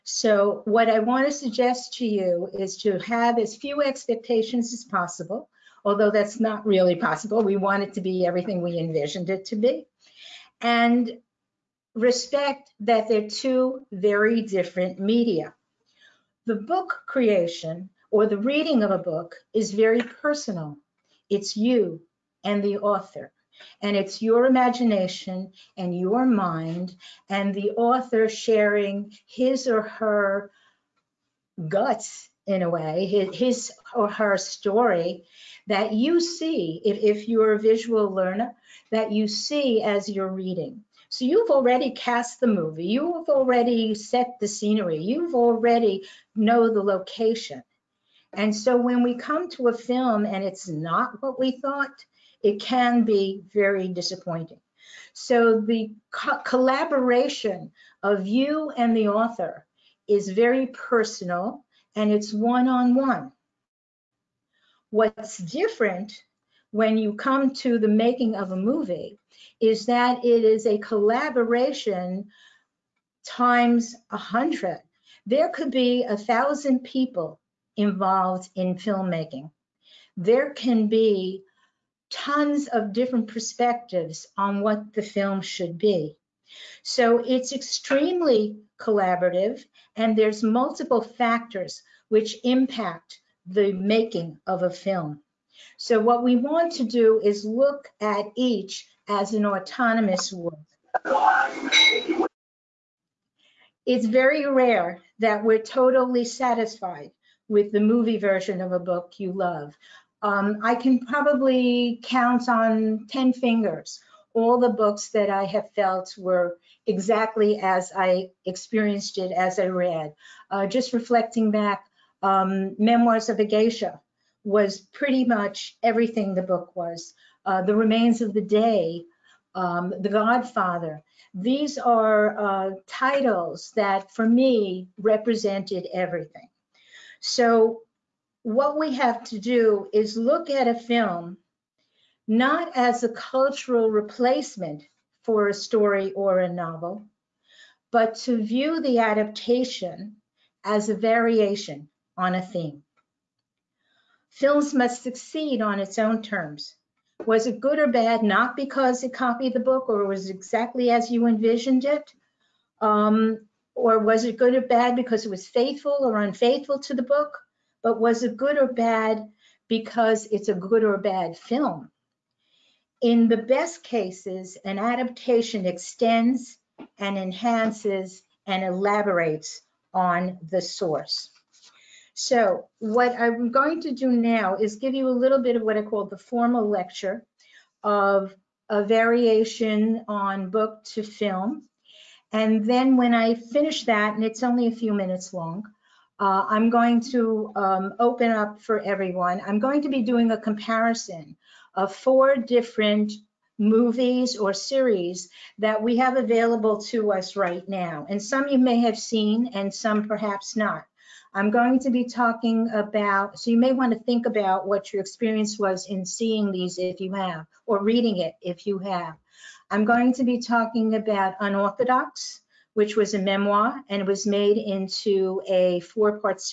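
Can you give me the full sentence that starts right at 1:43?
It's very rare that we're totally satisfied with the movie version of a book you love.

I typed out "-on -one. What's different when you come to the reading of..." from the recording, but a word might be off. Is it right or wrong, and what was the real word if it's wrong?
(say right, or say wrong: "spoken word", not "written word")
wrong: "making", not "reading".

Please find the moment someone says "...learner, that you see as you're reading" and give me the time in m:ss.
0:38.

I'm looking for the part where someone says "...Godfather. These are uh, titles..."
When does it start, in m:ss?
2:10.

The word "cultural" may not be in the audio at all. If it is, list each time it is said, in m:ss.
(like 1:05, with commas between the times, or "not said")
2:23.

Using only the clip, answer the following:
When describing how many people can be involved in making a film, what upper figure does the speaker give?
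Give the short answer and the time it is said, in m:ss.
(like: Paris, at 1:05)
1,000, at 1:16.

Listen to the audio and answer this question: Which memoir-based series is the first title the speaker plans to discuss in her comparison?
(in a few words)
Unorthodox.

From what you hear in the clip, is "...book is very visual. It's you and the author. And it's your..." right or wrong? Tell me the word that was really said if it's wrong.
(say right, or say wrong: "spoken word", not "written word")
wrong: "personal", not "visual".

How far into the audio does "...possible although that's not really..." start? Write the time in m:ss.
0:04.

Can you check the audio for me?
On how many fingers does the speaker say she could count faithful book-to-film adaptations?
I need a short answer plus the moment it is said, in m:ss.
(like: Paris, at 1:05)
10, at 1:53.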